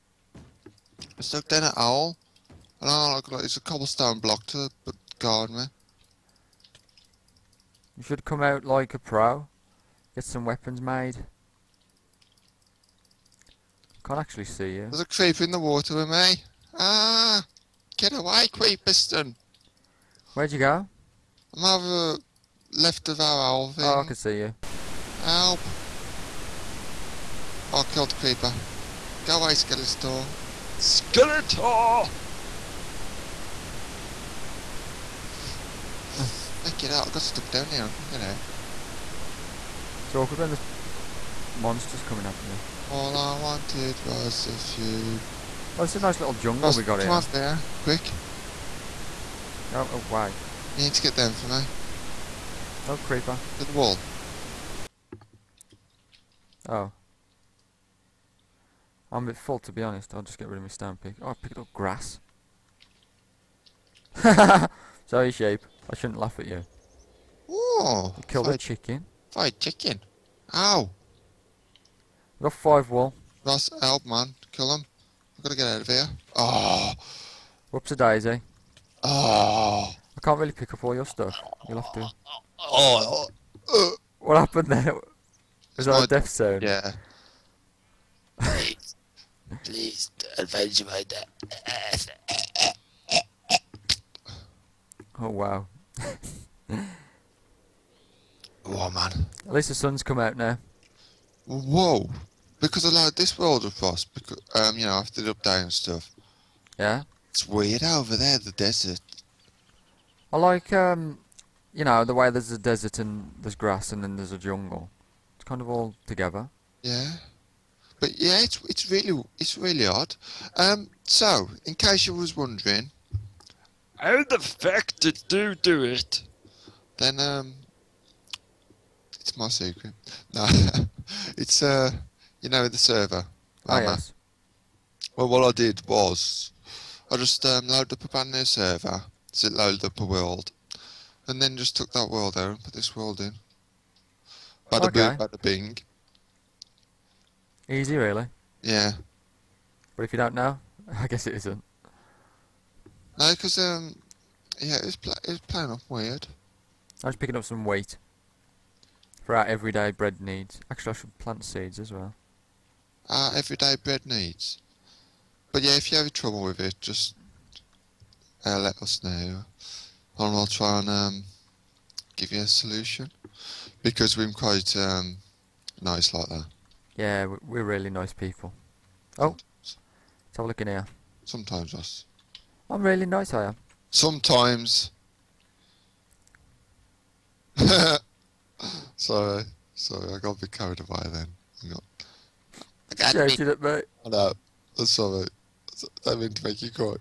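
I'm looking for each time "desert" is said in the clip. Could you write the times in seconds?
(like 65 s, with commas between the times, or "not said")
108 s, 112 s.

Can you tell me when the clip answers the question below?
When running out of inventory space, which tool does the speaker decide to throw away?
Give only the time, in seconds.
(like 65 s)
60 s.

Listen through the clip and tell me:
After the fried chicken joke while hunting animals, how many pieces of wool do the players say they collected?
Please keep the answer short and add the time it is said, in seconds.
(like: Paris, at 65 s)
5, at 72 s.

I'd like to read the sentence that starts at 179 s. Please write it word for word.
Oh, let's have a look in here.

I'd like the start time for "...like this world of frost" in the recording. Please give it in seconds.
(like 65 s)
103 s.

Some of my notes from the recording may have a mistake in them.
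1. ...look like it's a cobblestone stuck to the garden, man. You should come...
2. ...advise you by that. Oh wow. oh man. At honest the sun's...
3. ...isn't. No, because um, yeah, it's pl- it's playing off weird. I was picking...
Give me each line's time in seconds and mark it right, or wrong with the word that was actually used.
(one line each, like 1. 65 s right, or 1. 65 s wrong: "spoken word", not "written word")
1. 3 s wrong: "block", not "stuck"
2. 90 s wrong: "least", not "honest"
3. 151 s right.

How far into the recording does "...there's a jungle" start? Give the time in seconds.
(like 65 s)
114 s.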